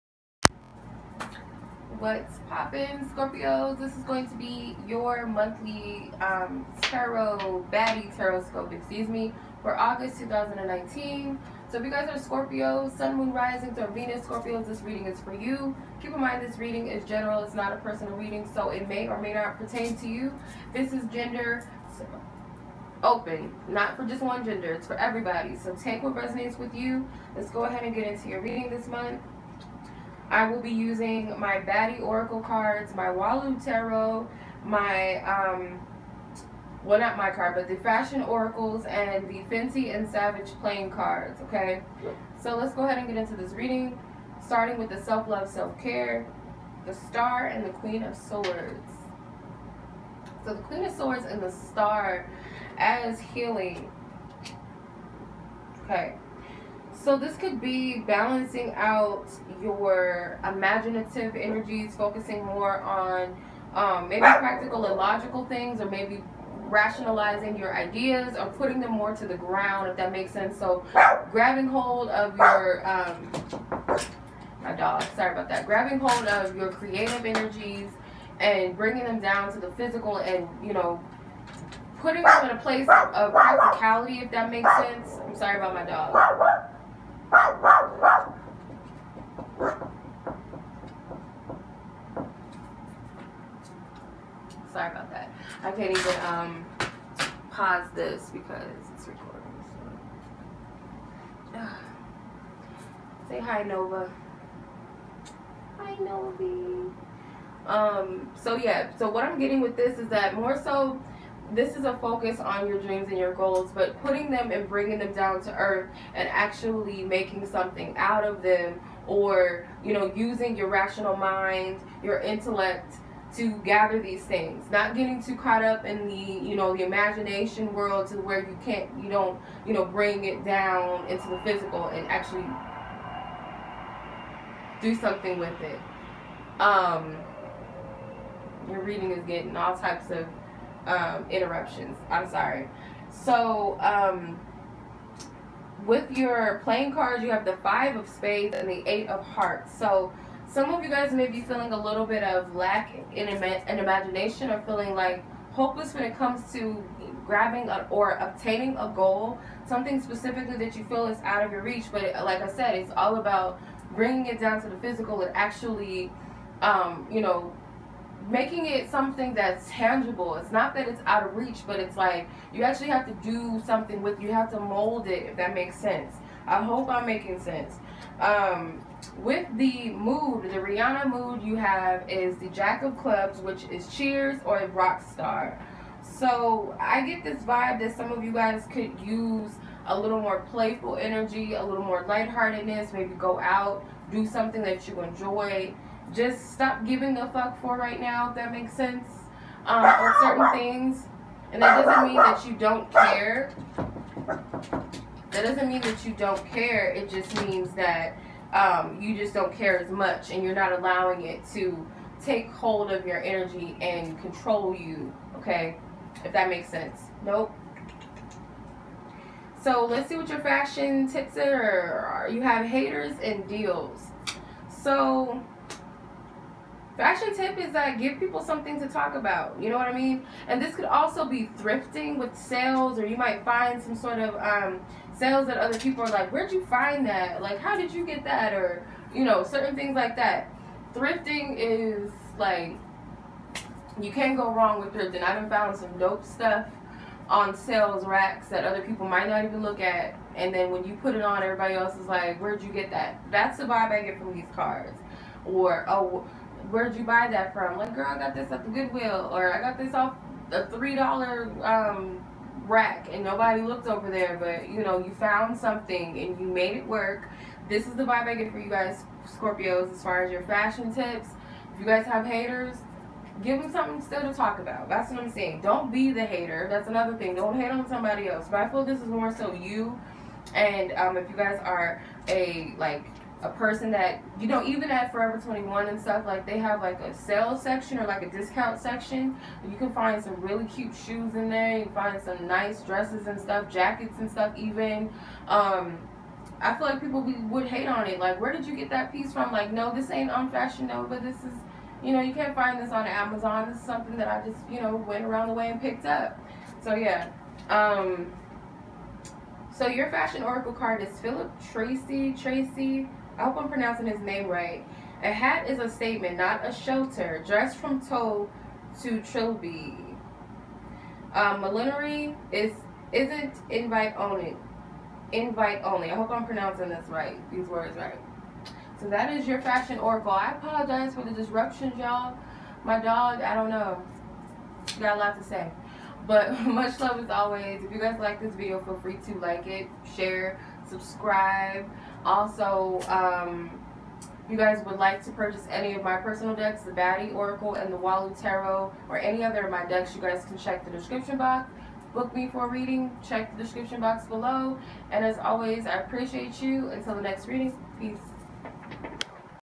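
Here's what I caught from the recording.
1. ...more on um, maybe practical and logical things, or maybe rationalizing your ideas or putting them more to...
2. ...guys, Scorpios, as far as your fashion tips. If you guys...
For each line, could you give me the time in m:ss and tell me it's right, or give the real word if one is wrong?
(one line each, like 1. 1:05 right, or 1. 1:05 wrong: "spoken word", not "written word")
1. 1:02 right
2. 4:28 right.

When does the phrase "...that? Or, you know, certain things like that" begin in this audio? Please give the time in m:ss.
3:58.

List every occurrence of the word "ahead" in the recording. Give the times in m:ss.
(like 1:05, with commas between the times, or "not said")
0:27, 0:42.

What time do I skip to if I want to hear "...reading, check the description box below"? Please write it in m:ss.
5:52.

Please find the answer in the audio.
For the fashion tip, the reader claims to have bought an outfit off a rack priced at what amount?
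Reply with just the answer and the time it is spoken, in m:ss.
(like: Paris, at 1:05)
$3, at 4:20.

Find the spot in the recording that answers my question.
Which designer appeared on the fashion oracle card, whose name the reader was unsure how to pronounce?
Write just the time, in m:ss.
5:11.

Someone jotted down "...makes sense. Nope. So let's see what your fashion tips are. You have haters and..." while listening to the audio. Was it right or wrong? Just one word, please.
right.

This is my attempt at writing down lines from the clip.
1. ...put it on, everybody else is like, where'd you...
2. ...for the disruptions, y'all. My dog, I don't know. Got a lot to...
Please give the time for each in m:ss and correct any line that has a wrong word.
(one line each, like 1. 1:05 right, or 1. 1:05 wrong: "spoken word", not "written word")
1. 4:11 right
2. 5:31 right.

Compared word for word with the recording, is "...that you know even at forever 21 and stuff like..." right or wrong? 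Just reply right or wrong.
right.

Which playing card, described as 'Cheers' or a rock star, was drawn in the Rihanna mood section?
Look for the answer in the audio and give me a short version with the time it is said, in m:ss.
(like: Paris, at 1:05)
Jack of Clubs, at 3:02.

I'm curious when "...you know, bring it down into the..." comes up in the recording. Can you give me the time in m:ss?
2:09.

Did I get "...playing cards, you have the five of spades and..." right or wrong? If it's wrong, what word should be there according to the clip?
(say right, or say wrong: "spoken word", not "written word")
right.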